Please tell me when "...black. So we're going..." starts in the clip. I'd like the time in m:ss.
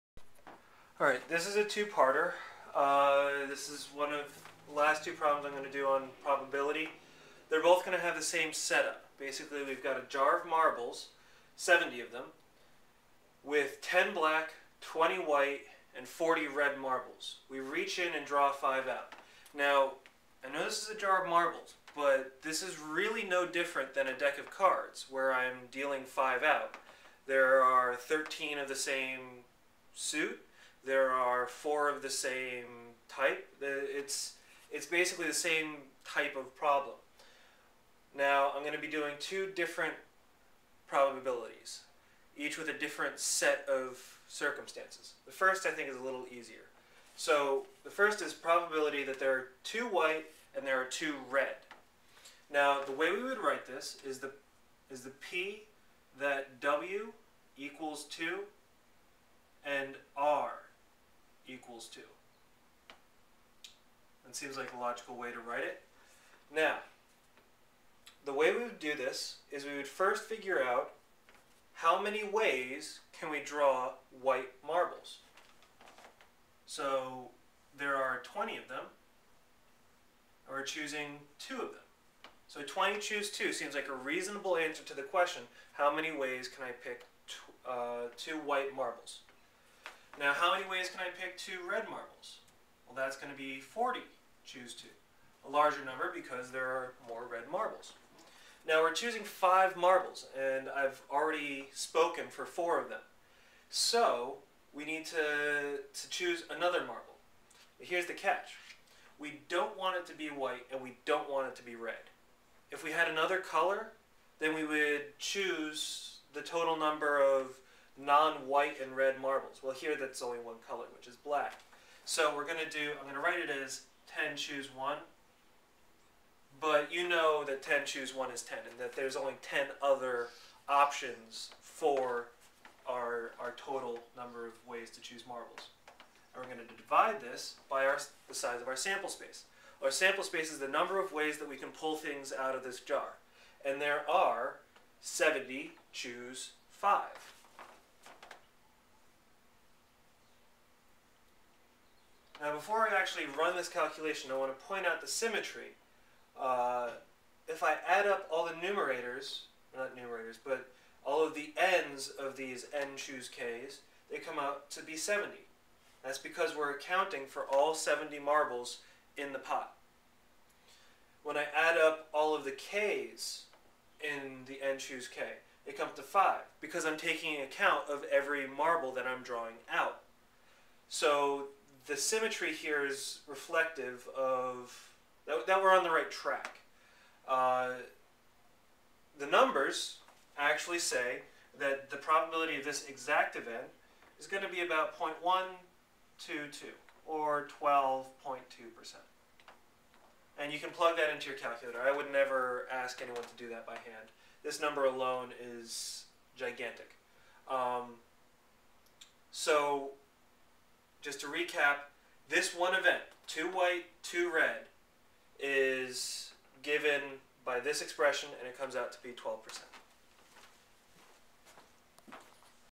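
2:01.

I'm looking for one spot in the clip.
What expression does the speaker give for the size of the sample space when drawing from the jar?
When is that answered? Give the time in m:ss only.
2:25.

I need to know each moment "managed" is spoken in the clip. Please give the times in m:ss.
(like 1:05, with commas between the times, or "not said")
not said.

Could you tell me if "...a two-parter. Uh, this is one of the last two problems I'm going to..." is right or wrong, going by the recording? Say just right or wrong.
right.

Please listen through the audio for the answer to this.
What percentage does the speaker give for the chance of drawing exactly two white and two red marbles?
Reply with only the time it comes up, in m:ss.
3:17.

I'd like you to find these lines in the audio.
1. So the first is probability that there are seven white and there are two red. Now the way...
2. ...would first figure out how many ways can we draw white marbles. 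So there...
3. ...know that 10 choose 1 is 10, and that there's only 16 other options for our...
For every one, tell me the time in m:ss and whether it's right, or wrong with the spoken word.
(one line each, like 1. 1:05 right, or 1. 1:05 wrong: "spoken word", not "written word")
1. 0:47 wrong: "two", not "seven"
2. 1:09 right
3. 2:07 wrong: "10", not "16".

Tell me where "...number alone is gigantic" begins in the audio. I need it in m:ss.
3:24.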